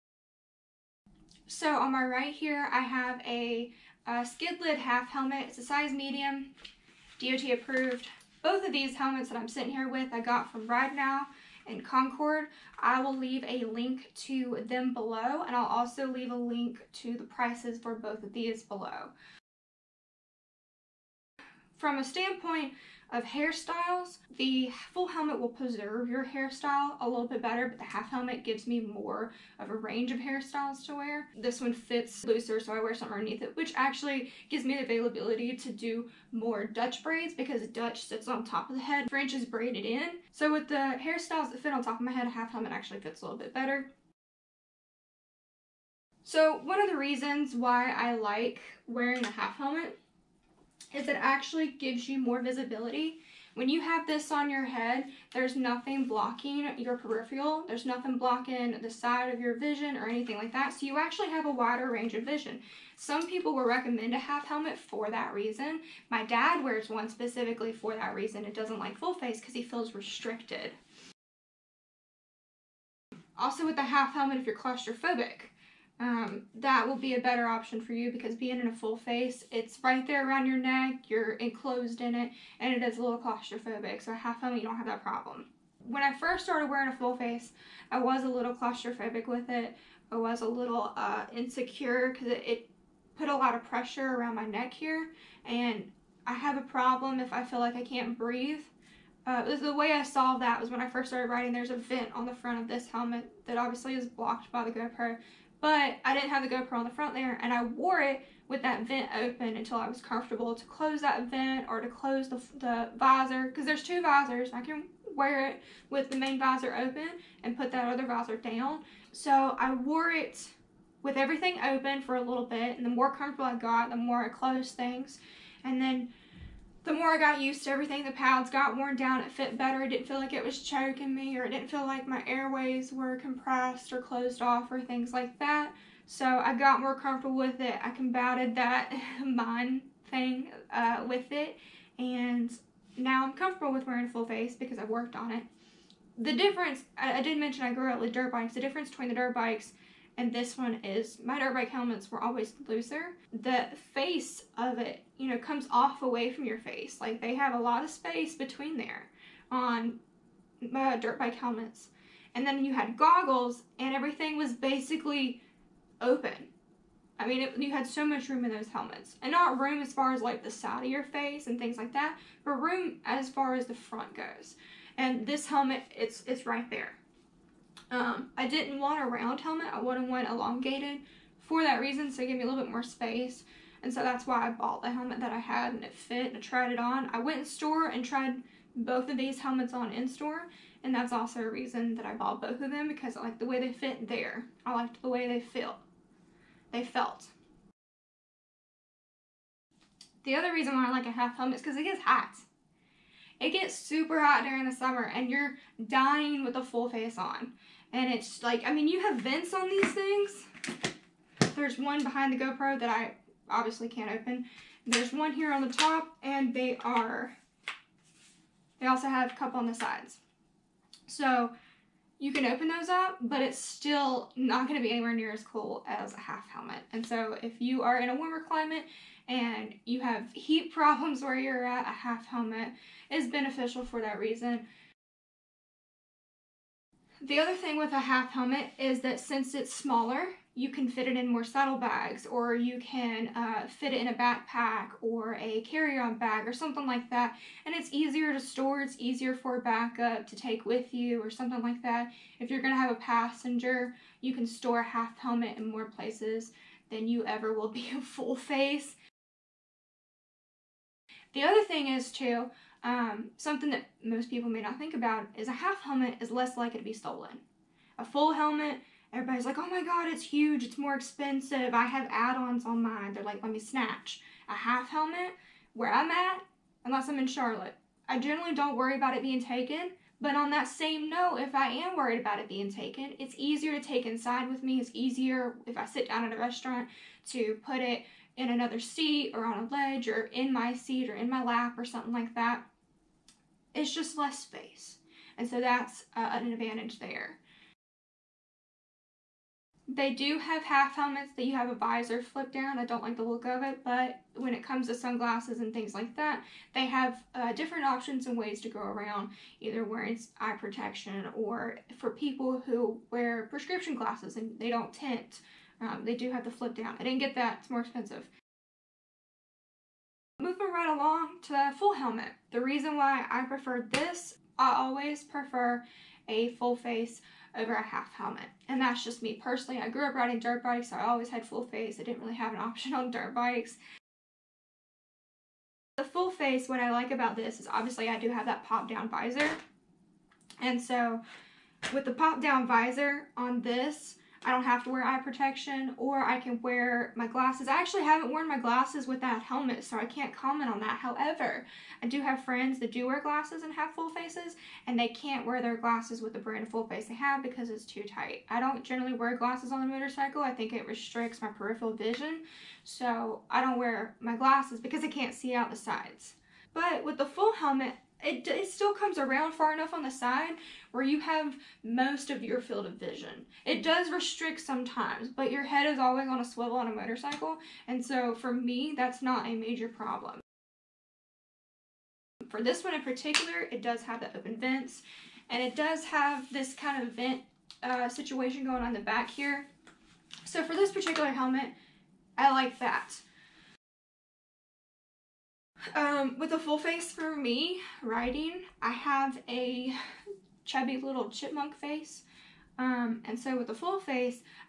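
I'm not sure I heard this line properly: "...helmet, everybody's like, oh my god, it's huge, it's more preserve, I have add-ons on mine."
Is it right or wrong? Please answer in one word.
wrong.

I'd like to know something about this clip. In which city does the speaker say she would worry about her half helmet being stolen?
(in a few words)
Charlotte.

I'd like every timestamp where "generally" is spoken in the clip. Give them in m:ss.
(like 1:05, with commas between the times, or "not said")
4:38, 5:58.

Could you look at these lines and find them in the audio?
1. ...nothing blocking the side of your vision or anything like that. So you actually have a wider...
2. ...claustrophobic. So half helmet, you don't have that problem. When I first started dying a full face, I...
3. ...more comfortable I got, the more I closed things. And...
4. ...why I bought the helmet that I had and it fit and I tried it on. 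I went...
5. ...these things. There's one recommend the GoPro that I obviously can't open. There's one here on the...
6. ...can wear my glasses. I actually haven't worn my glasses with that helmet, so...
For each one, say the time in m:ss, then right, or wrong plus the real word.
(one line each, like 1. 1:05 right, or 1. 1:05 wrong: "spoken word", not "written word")
1. 0:57 right
2. 1:23 wrong: "wearing", not "dying"
3. 2:02 right
4. 3:04 right
5. 3:29 wrong: "behind", not "recommend"
6. 5:46 right.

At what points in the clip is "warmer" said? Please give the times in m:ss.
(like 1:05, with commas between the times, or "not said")
3:48.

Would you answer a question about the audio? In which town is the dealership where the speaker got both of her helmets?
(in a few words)
Concord.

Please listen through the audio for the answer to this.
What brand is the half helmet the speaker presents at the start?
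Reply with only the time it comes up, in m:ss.
0:04.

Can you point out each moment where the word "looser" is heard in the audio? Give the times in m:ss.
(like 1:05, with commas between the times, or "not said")
0:32, 2:32.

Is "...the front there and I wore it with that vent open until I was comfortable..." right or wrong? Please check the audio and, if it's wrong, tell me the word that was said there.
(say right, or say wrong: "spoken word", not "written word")
right.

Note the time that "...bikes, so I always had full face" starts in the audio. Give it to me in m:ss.
5:30.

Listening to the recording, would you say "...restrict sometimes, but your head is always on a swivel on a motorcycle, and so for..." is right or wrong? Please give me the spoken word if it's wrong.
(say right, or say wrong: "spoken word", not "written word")
right.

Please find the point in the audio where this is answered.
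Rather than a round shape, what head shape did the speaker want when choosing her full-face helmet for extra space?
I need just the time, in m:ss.
3:00.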